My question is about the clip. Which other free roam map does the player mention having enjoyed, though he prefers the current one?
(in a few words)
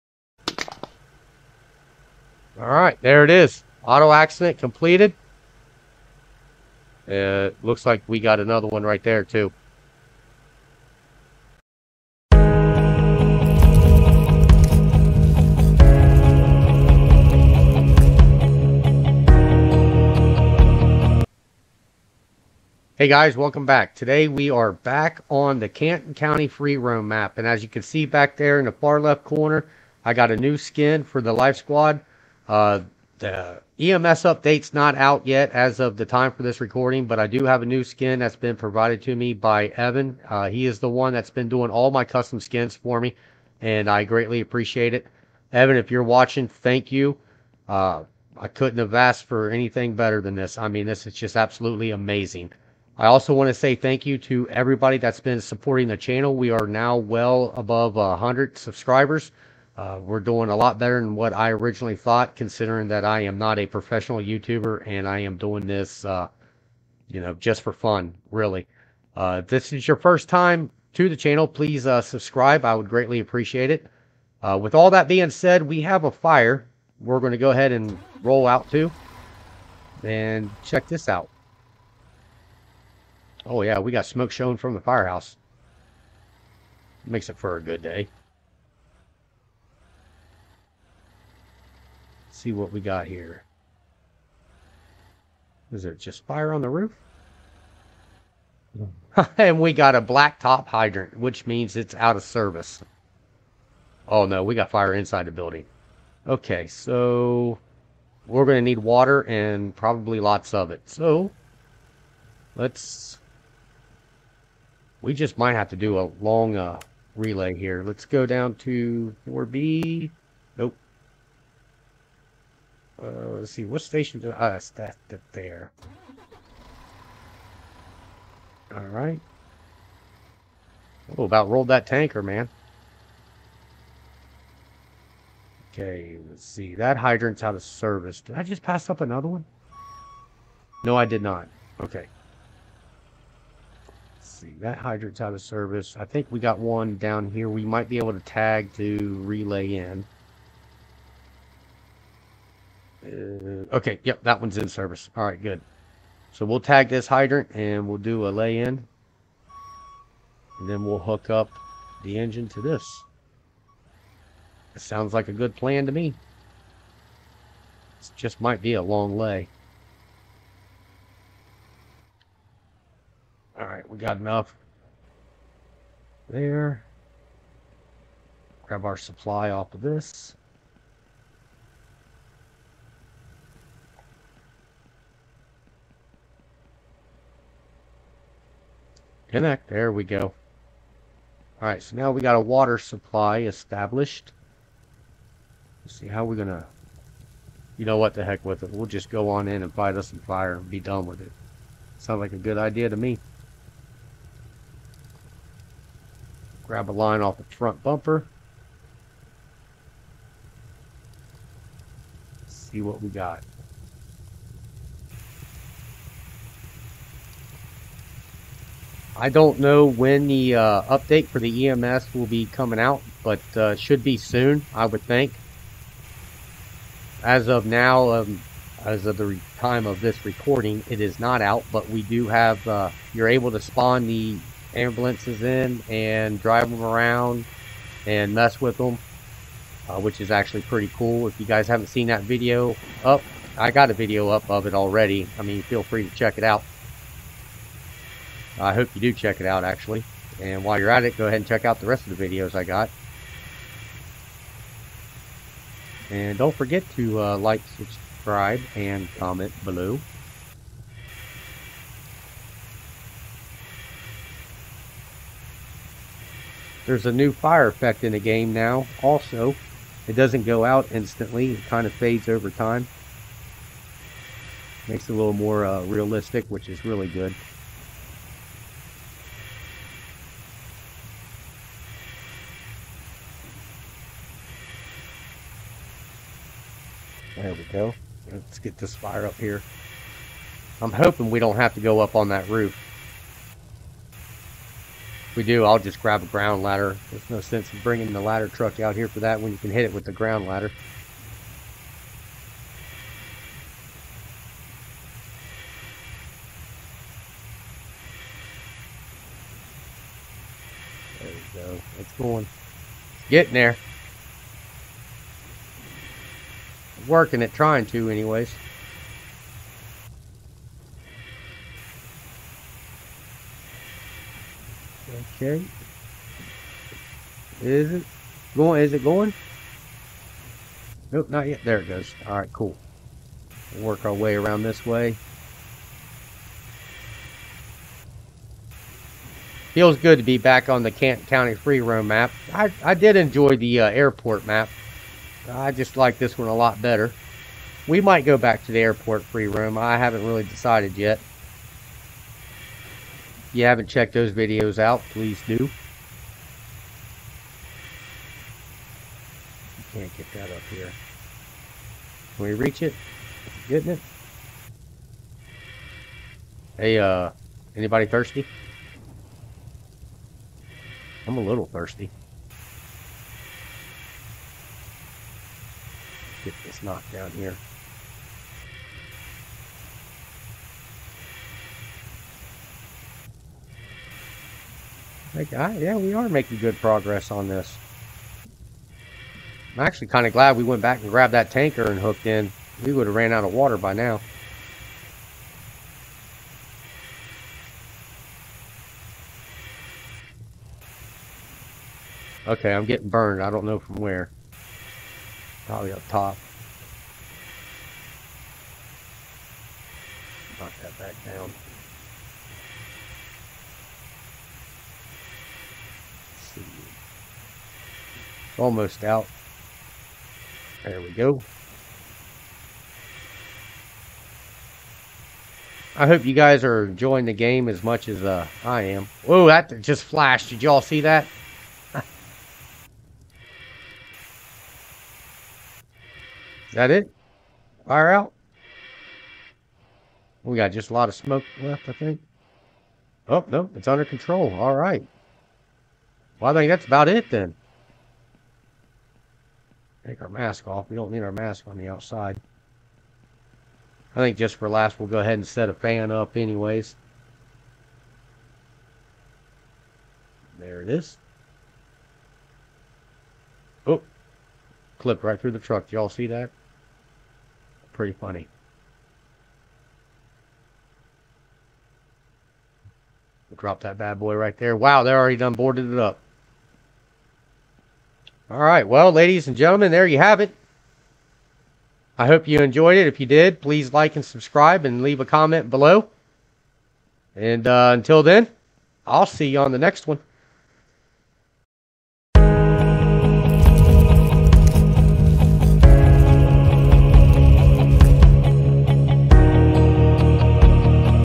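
airport map.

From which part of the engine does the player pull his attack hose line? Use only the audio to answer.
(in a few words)
front bumper.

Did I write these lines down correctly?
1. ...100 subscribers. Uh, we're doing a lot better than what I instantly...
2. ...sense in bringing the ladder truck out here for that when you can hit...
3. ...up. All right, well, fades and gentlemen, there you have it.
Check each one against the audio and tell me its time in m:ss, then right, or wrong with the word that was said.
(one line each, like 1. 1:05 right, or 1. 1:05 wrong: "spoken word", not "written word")
1. 0:57 wrong: "originally", not "instantly"
2. 4:57 right
3. 7:55 wrong: "ladies", not "fades".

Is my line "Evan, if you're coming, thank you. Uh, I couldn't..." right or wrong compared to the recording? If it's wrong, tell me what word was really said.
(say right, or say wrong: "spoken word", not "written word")
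wrong: "watching", not "coming".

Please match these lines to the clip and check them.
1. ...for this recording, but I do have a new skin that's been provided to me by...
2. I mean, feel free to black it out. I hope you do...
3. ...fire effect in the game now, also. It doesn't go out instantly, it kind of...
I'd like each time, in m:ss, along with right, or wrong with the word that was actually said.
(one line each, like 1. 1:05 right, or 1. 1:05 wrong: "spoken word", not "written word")
1. 0:36 right
2. 4:05 wrong: "check", not "black"
3. 4:27 right.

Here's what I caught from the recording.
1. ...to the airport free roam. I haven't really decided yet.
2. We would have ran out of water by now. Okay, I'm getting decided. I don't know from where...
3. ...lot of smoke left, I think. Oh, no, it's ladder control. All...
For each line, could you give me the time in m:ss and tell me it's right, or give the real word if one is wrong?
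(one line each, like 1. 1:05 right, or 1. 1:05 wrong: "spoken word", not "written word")
1. 5:48 right
2. 6:32 wrong: "burned", not "decided"
3. 7:20 wrong: "under", not "ladder".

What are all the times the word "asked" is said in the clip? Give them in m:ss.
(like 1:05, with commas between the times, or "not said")
0:48.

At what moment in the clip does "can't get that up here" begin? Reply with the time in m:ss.
5:59.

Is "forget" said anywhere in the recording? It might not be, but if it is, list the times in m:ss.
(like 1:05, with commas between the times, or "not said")
4:16.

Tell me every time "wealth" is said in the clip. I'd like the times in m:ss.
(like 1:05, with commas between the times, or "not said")
not said.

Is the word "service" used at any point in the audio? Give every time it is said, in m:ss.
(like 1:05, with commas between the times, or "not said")
1:42, 2:17, 2:25, 2:34.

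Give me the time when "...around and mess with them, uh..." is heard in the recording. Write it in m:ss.
3:56.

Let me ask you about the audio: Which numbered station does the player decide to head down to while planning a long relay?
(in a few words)
4B.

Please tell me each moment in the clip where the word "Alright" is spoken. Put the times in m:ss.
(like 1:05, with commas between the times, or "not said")
2:08, 2:53.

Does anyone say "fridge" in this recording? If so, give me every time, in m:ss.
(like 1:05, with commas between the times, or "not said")
not said.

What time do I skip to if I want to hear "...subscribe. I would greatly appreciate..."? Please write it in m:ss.
1:12.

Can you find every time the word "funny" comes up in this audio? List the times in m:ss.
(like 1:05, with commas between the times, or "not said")
7:48.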